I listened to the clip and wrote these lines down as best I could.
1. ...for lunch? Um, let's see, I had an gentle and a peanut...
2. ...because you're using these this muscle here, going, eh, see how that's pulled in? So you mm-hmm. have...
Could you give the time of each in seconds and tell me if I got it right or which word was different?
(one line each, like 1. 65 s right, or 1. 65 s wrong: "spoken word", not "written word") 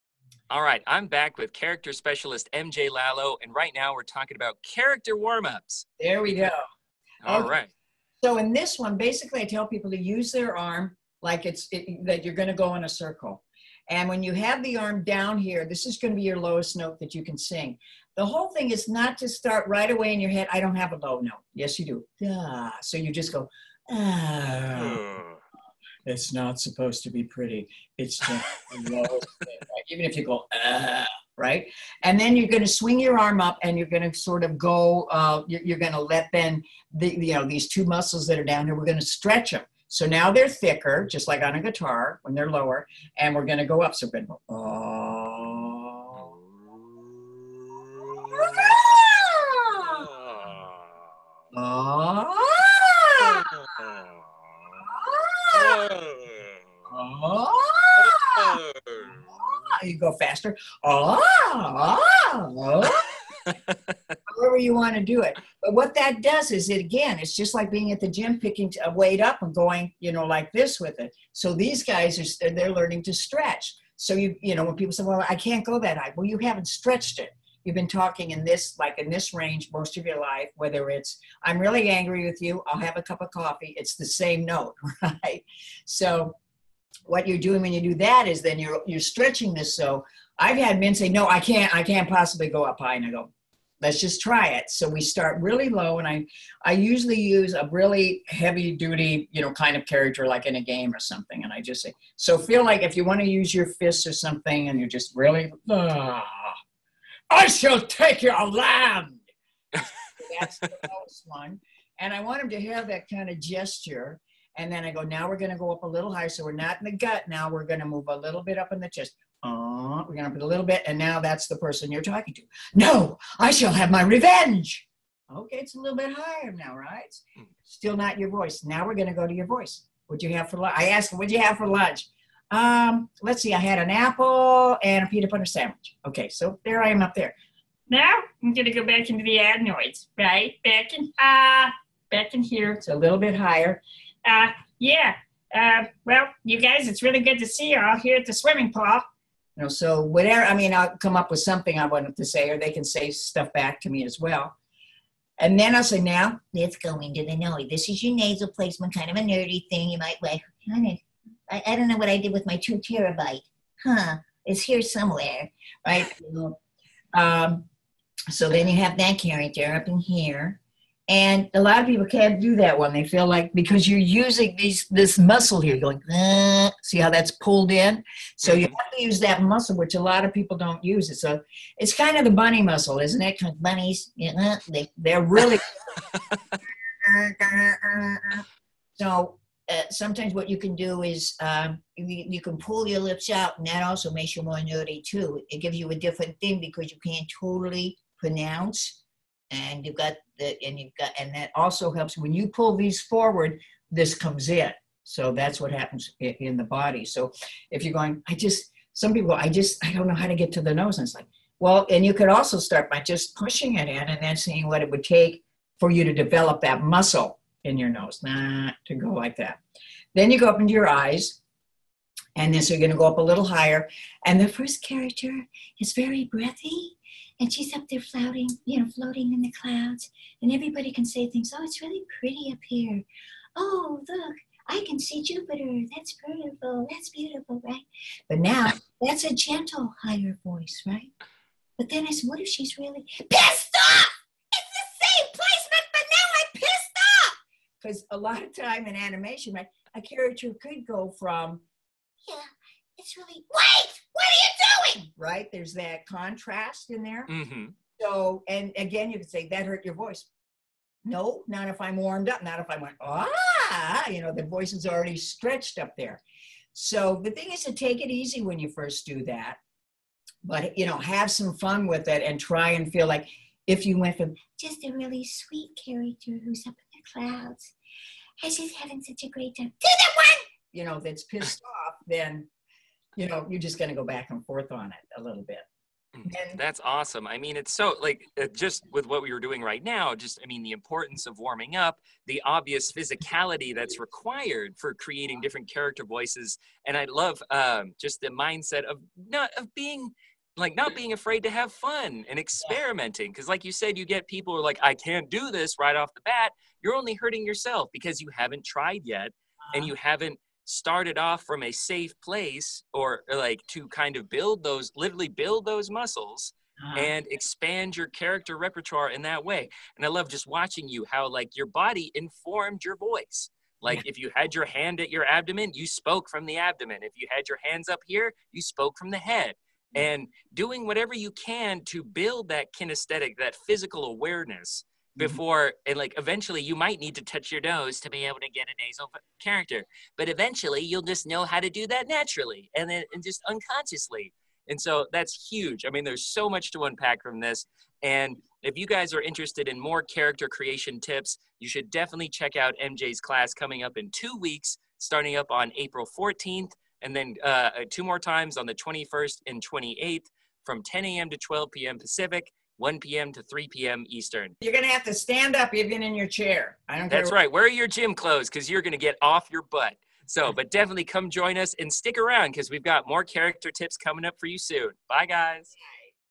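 1. 131 s wrong: "apple", not "gentle"
2. 173 s right.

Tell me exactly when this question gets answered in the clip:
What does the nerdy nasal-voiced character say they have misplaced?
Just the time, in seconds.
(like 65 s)
162 s.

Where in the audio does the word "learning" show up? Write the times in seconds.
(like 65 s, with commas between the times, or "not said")
72 s.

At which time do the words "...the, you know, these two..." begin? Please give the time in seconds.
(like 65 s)
36 s.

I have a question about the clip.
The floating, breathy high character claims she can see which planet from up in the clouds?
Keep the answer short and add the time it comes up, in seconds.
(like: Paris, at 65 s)
Jupiter, at 235 s.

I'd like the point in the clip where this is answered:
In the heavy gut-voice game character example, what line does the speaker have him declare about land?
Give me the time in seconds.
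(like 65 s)
107 s.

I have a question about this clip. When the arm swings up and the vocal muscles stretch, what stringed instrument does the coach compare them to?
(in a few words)
Guitar.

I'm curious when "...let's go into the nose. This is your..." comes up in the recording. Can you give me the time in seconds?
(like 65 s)
156 s.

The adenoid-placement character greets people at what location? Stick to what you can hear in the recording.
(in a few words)
The swimming pool.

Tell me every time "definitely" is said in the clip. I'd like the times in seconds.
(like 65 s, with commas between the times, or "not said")
351 s, 370 s.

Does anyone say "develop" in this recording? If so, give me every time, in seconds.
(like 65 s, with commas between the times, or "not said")
216 s.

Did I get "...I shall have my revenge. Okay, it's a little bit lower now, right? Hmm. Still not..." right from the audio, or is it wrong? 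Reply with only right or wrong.
wrong.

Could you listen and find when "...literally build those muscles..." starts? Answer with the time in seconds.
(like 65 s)
314 s.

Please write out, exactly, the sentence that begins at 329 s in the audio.
and doing whatever you can to build that kinesthetic that physical awareness Mm-hmm.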